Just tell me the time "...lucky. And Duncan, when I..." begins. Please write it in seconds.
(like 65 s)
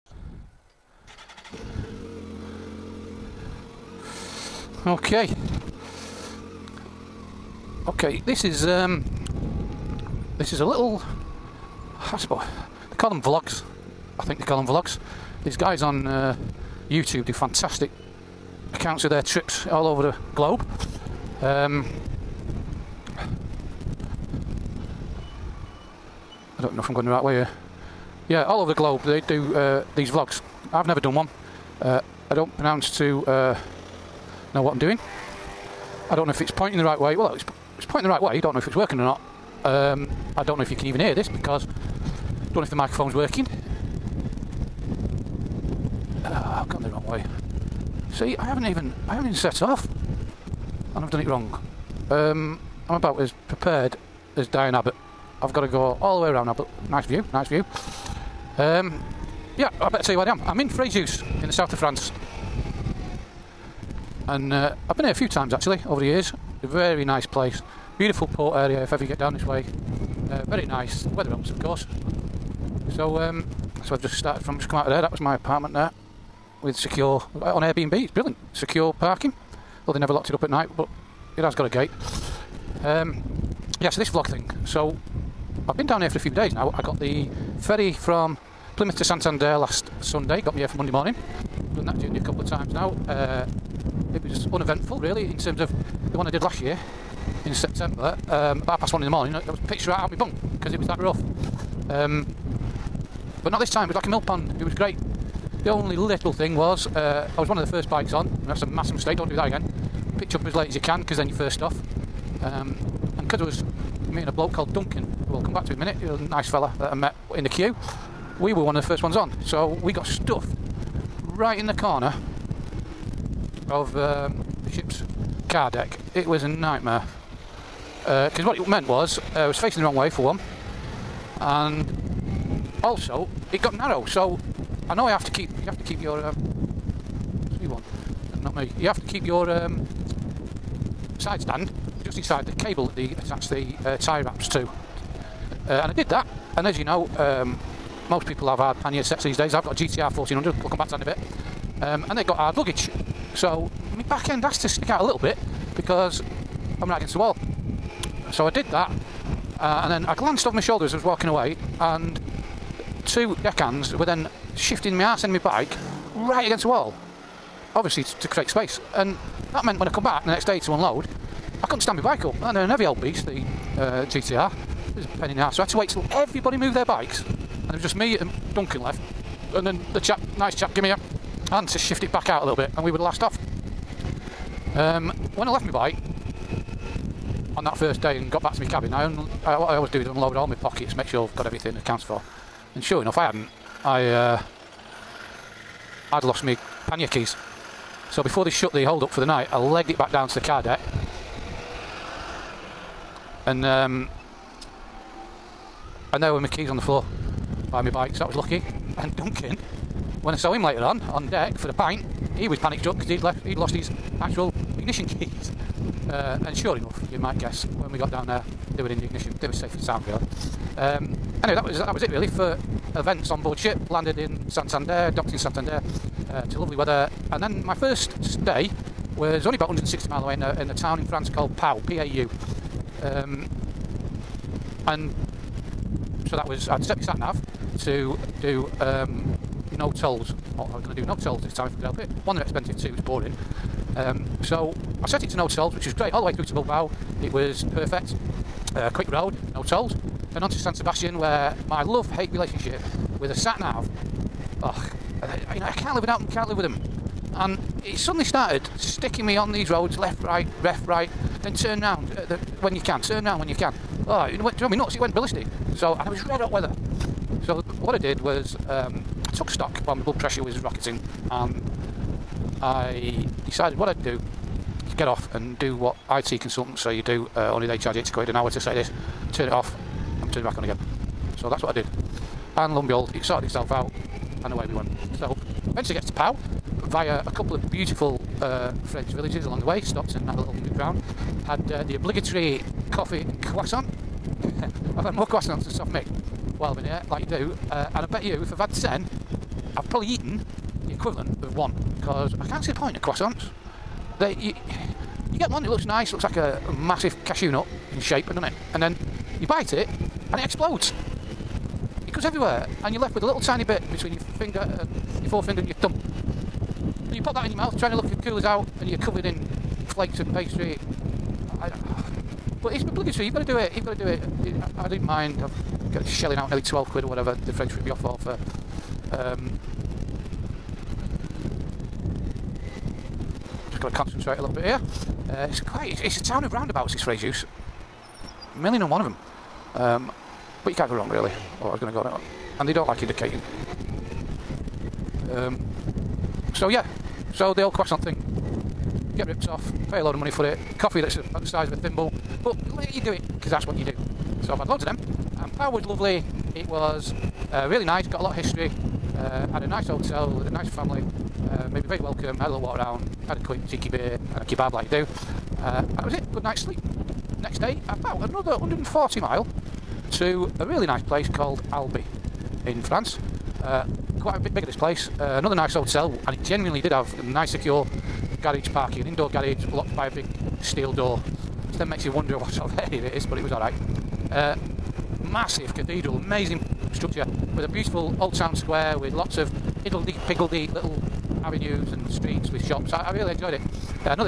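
208 s.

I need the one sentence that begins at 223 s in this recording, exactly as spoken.
Landed in Santander, docked in Santander.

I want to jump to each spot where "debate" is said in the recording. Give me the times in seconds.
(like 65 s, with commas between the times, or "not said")
not said.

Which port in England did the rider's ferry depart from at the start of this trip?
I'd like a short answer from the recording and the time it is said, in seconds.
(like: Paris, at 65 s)
Plymouth, at 88 s.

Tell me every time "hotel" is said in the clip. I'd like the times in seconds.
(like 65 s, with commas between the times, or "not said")
359 s, 375 s.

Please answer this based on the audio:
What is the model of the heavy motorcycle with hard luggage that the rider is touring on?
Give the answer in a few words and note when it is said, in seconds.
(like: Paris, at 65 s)
GTR 1400, at 149 s.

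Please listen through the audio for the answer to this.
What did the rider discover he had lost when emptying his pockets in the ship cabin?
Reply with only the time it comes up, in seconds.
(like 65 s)
196 s.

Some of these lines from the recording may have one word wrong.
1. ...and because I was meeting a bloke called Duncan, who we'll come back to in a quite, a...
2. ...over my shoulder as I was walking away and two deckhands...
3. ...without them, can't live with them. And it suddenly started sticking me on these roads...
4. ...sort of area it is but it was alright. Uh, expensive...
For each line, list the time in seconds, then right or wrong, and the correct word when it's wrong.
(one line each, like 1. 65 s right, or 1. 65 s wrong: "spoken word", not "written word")
1. 113 s wrong: "minute", not "quite"
2. 160 s right
3. 256 s right
4. 382 s wrong: "massive", not "expensive".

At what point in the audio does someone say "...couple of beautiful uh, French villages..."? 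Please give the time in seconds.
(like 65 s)
287 s.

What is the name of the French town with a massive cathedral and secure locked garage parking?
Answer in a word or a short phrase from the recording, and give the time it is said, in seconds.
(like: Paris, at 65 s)
Albi, at 371 s.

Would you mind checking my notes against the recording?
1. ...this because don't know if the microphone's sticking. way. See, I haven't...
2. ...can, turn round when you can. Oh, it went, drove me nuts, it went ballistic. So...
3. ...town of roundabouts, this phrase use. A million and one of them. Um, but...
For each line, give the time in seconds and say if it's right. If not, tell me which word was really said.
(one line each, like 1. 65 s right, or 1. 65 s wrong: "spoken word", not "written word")
1. 41 s wrong: "working", not "sticking"
2. 262 s right
3. 336 s right.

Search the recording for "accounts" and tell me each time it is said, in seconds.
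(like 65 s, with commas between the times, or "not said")
18 s, 191 s.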